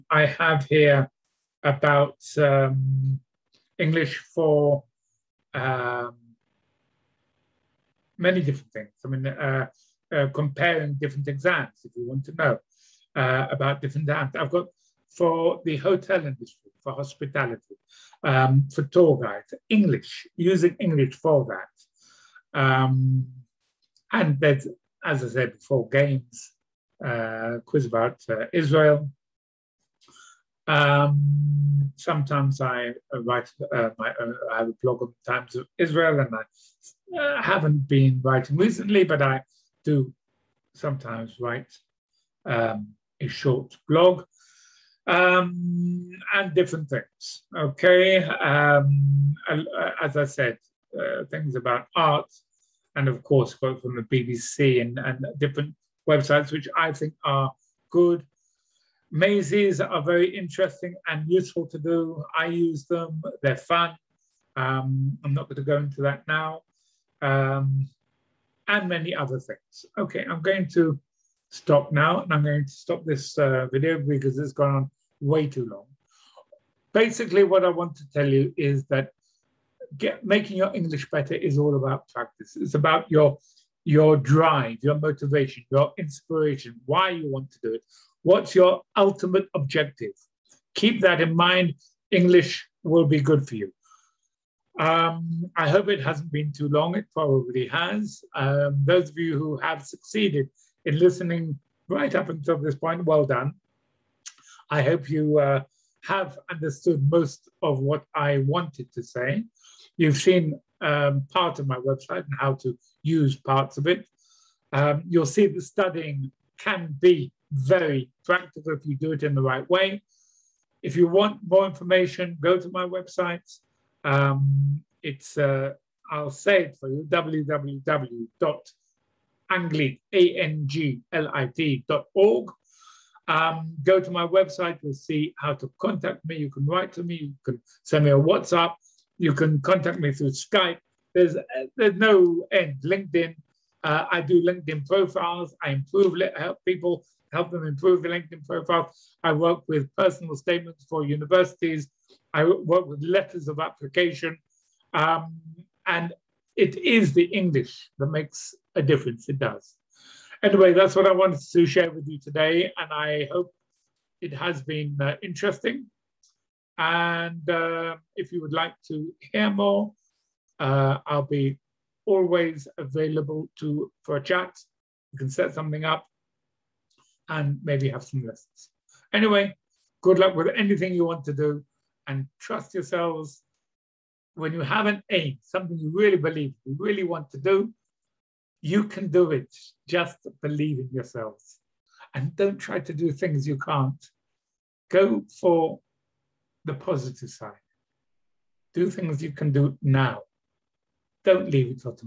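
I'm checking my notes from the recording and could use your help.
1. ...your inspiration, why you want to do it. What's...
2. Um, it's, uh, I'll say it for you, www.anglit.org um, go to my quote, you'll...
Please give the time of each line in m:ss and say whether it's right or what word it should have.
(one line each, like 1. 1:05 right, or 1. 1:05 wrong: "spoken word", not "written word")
1. 1:25 right
2. 2:04 wrong: "website", not "quote".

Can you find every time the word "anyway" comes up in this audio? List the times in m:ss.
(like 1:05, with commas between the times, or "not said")
2:40, 2:59.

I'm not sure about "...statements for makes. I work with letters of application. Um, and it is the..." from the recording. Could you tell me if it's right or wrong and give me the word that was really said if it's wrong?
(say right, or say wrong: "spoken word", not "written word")
wrong: "universities", not "makes".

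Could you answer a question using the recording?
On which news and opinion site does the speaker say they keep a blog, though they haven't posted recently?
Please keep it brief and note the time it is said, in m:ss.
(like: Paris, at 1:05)
Times of Israel, at 0:35.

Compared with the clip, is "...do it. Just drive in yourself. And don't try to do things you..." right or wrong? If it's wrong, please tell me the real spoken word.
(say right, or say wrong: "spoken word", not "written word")
wrong: "believe", not "drive".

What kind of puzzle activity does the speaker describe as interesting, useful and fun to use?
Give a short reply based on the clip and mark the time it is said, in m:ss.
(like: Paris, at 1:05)
Mazes, at 0:59.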